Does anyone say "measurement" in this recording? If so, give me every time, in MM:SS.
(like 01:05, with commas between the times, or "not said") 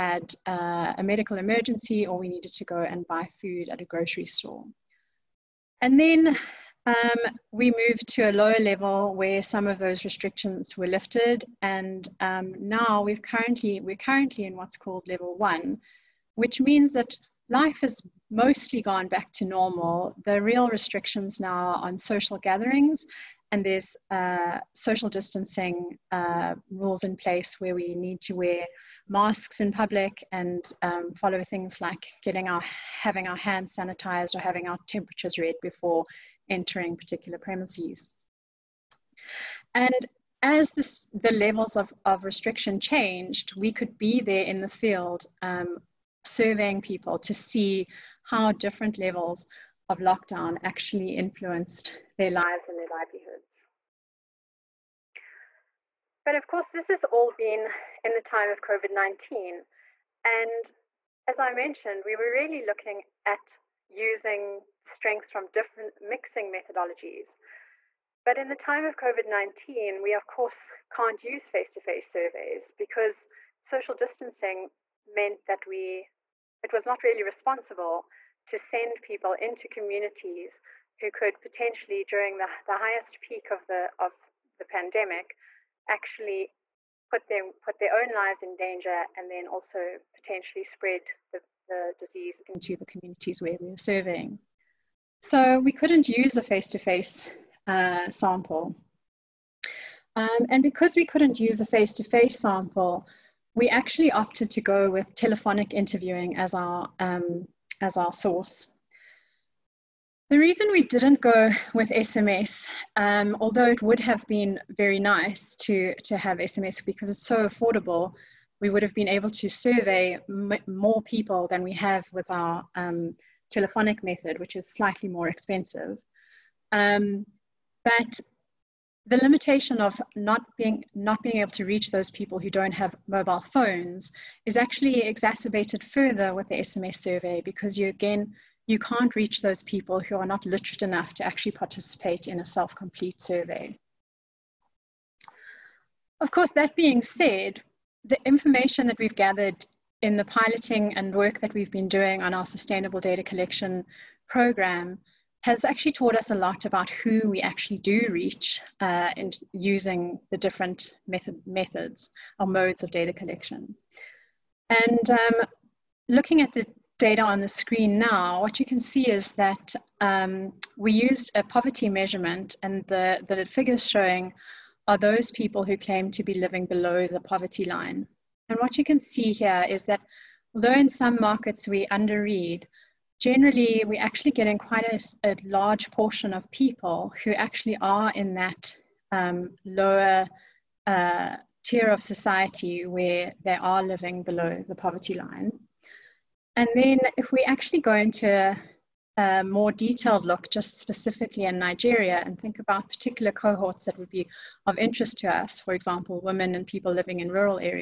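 02:51.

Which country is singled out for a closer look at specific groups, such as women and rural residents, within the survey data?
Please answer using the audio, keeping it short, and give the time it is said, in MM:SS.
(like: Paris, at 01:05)
Nigeria, at 03:21.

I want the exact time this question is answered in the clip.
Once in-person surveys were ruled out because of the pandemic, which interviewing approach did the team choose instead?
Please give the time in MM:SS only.
01:45.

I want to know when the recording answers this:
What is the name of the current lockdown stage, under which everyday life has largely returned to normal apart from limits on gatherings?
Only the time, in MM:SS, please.
00:15.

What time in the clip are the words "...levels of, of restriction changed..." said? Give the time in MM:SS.
00:41.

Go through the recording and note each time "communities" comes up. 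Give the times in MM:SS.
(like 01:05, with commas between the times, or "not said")
01:19, 01:32.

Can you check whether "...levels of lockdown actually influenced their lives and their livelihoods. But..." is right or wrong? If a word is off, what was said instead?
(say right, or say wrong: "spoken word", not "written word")
right.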